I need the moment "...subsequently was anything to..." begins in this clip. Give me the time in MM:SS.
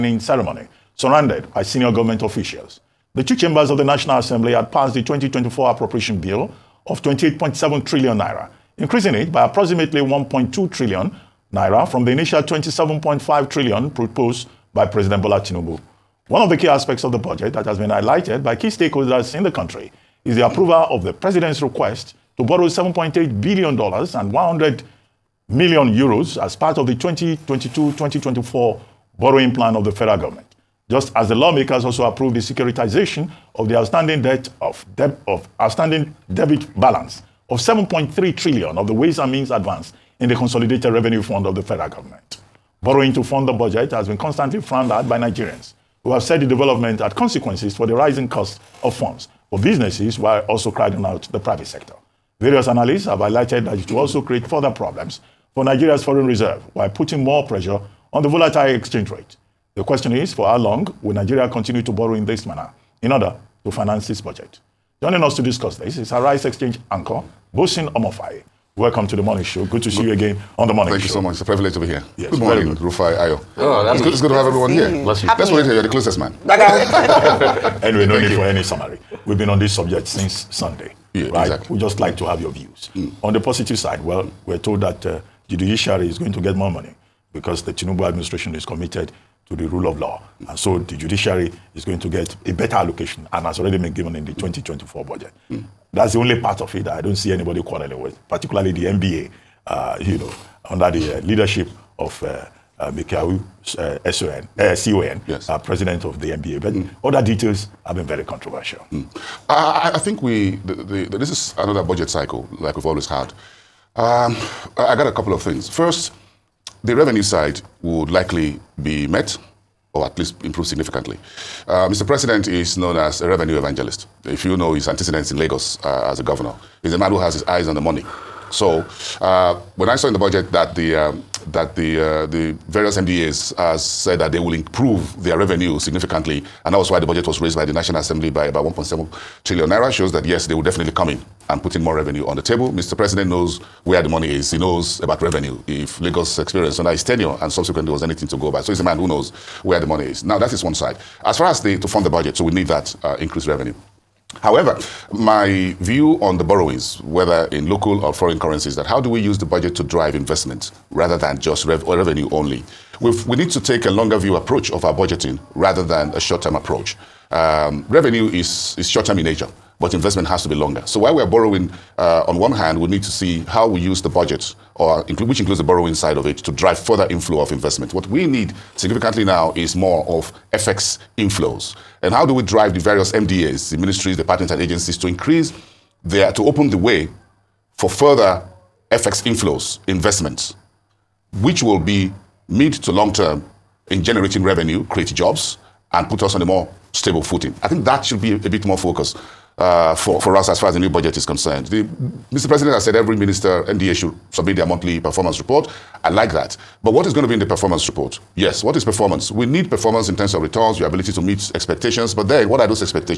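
02:27.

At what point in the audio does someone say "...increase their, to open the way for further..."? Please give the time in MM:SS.
03:05.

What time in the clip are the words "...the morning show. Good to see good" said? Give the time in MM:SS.
01:09.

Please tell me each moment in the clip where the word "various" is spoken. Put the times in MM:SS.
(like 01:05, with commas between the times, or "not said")
00:52, 02:12, 03:02.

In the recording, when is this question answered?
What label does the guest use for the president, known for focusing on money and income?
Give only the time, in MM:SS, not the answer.
02:03.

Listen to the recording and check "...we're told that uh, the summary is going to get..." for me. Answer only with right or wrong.
wrong.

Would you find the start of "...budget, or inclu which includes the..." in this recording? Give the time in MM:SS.
02:54.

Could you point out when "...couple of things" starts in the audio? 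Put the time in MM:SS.
01:55.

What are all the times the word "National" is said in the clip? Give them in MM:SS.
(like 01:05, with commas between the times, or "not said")
00:03, 02:17.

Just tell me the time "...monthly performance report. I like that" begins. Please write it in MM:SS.
03:24.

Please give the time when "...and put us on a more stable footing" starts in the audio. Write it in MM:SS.
03:15.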